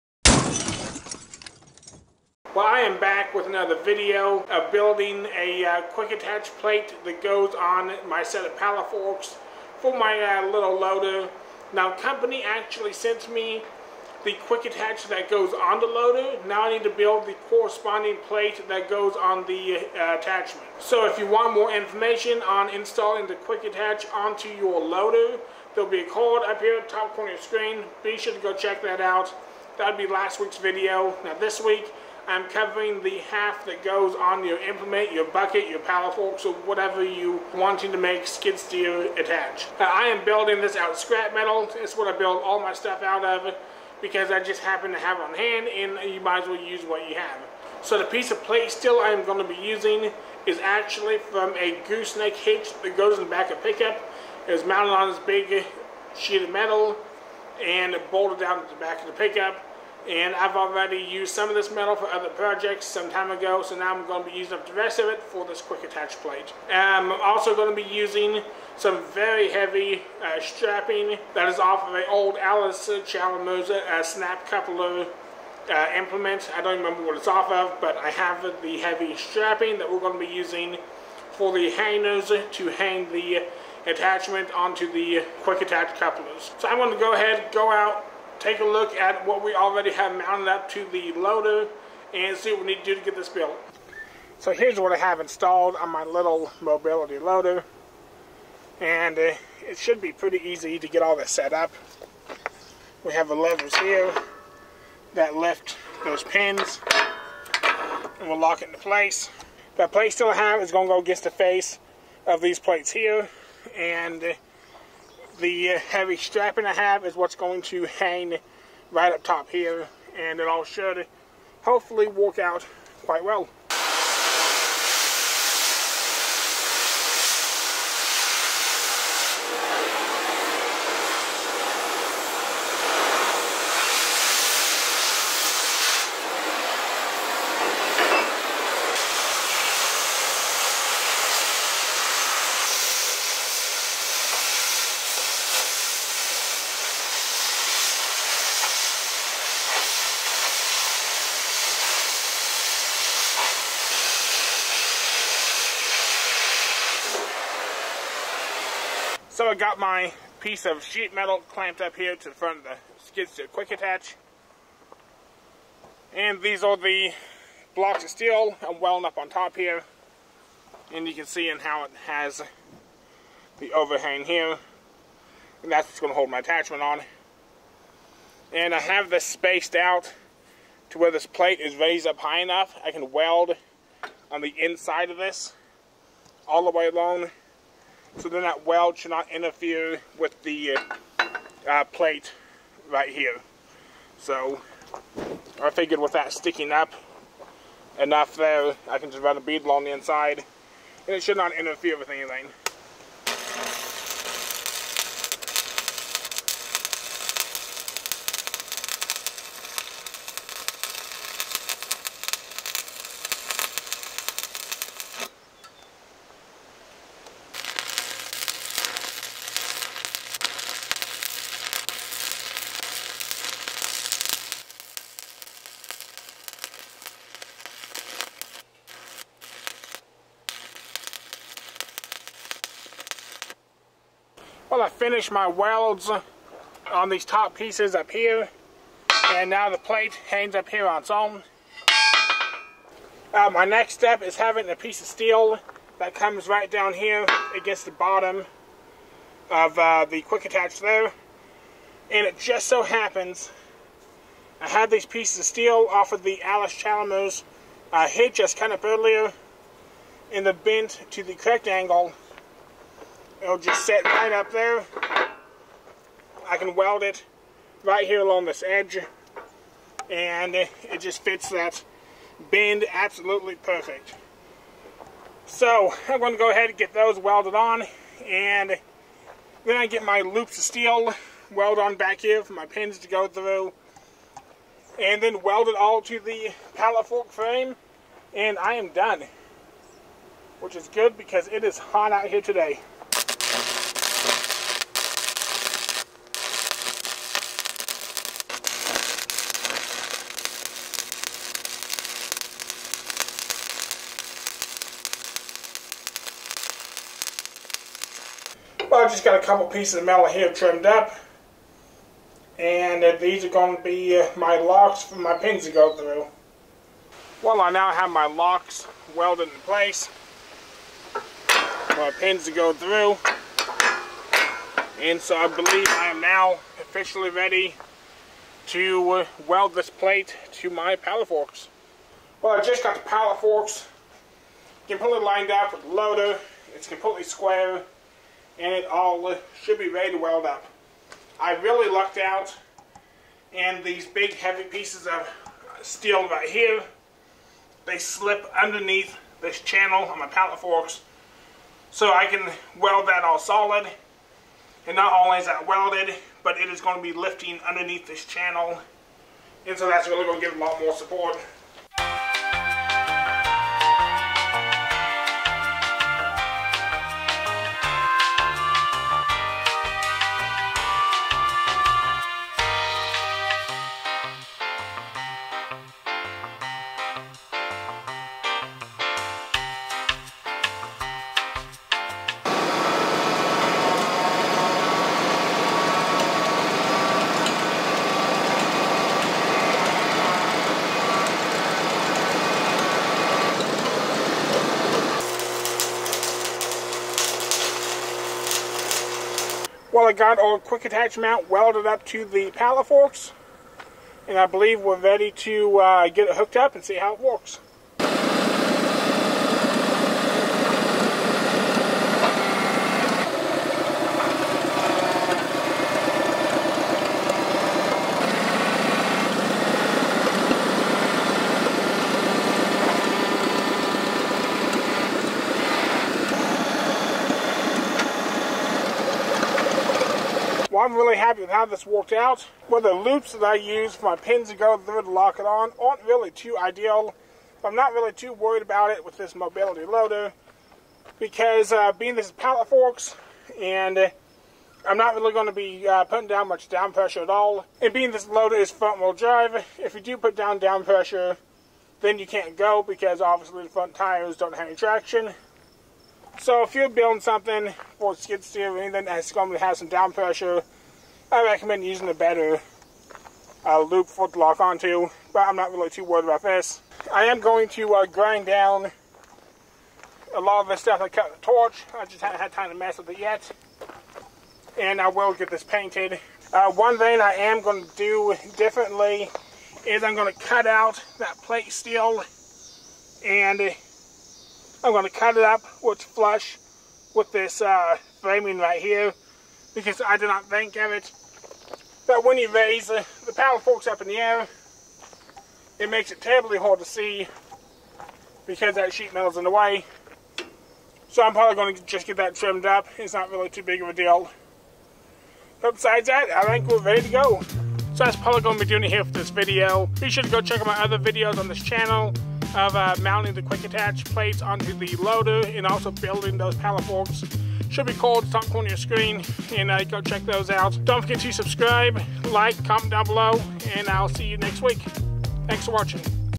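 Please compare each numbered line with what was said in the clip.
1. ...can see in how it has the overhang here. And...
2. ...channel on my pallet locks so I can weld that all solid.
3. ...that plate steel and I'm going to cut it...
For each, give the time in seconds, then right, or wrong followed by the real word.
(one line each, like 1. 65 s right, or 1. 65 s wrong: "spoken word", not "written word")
1. 171 s right
2. 349 s wrong: "forks", not "locks"
3. 481 s right.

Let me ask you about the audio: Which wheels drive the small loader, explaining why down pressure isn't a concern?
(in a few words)
Front wheel drive.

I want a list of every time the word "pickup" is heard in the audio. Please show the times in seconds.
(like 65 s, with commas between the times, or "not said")
53 s, 59 s.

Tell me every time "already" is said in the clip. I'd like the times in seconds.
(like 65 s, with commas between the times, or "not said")
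60 s, 89 s.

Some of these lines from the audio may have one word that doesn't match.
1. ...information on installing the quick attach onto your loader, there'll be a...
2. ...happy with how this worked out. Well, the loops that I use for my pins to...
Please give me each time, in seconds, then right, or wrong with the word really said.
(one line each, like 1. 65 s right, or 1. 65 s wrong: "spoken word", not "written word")
1. 21 s right
2. 431 s right.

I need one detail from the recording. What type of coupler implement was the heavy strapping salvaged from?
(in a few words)
Snap coupler.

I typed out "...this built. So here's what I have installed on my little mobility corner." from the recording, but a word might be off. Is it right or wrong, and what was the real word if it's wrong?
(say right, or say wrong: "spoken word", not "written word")
wrong: "loader", not "corner".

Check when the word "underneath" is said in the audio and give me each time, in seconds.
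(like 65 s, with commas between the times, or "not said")
348 s, 357 s.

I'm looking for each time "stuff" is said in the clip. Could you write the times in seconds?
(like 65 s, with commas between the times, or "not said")
42 s, 470 s.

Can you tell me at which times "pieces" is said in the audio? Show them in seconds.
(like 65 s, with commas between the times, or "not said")
48 s, 160 s, 237 s, 244 s, 255 s, 309 s, 344 s.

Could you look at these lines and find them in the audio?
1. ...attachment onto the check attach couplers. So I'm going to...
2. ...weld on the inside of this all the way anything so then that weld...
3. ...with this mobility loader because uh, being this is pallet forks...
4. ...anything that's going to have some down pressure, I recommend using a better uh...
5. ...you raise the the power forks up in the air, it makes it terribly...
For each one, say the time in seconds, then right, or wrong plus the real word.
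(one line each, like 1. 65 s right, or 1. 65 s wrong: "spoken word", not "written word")
1. 83 s wrong: "quick", not "check"
2. 183 s wrong: "along", not "anything"
3. 439 s right
4. 458 s right
5. 492 s right.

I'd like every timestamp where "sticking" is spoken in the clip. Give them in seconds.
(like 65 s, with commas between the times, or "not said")
196 s.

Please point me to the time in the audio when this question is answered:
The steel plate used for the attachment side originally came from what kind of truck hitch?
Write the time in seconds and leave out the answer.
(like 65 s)
51 s.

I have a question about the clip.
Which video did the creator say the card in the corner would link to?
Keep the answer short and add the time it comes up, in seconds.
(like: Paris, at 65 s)
Last week's video, at 30 s.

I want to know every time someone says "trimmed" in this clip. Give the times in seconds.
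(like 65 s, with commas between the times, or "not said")
310 s, 502 s.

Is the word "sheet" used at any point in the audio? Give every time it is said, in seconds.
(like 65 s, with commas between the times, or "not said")
56 s, 160 s, 498 s.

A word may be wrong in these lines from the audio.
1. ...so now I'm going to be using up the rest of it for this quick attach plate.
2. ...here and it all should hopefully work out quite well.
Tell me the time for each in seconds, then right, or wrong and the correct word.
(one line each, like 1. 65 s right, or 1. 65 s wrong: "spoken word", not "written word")
1. 63 s right
2. 119 s right.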